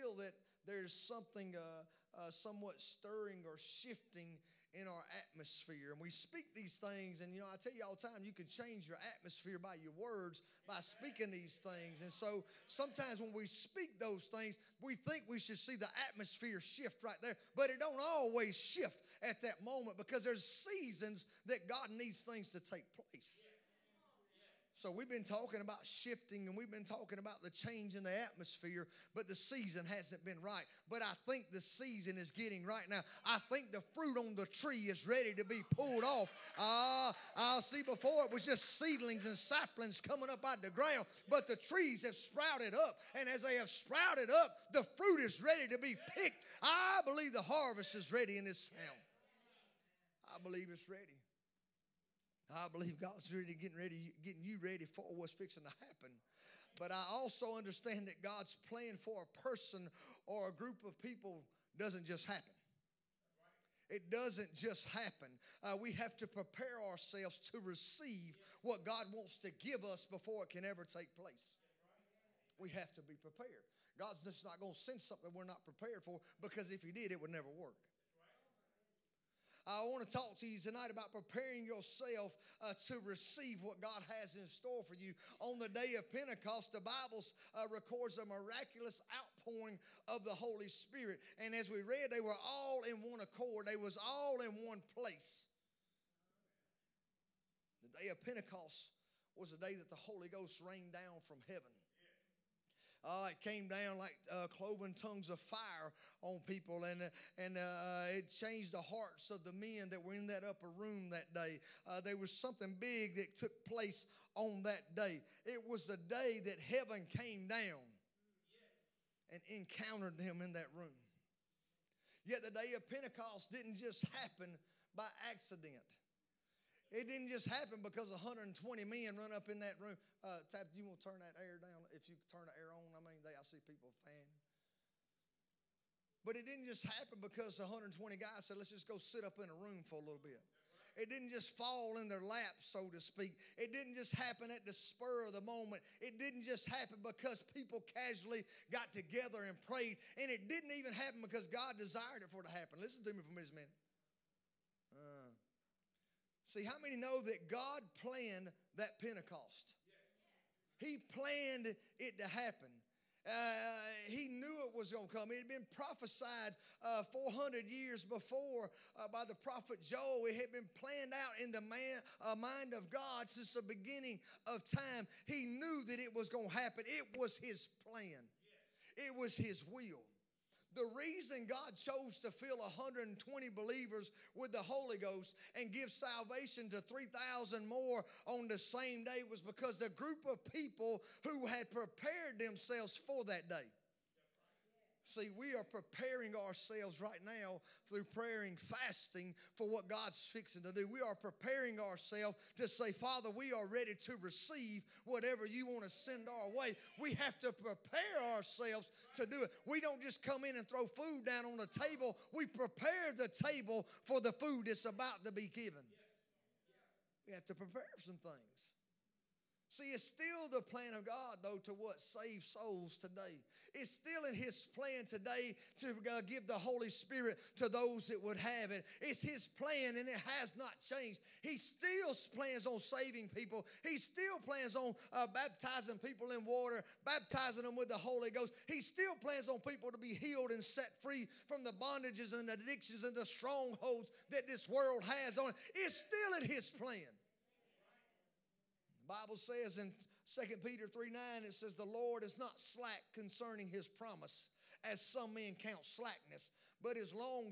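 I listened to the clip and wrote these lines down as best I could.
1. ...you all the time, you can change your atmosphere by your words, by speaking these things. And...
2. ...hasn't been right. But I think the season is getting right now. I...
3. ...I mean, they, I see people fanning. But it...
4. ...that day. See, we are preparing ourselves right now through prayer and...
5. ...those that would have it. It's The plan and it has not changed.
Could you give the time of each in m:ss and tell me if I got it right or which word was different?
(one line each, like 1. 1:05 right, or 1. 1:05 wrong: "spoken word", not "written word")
1. 0:07 right
2. 0:29 right
3. 2:12 right
4. 3:13 right
5. 3:47 wrong: "His", not "The".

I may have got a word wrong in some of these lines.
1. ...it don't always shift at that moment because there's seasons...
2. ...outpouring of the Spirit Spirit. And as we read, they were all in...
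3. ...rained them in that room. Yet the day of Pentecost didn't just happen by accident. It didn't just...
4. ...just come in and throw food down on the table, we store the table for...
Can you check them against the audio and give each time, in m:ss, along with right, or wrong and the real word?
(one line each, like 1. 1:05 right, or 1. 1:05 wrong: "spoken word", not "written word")
1. 0:17 right
2. 1:29 wrong: "Holy", not "Spirit"
3. 1:59 wrong: "encountered", not "rained"
4. 3:30 wrong: "prepare", not "store".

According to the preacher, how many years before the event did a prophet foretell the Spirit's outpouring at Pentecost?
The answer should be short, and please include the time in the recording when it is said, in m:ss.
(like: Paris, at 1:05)
400, at 2:47.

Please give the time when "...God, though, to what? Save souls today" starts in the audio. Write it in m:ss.
3:41.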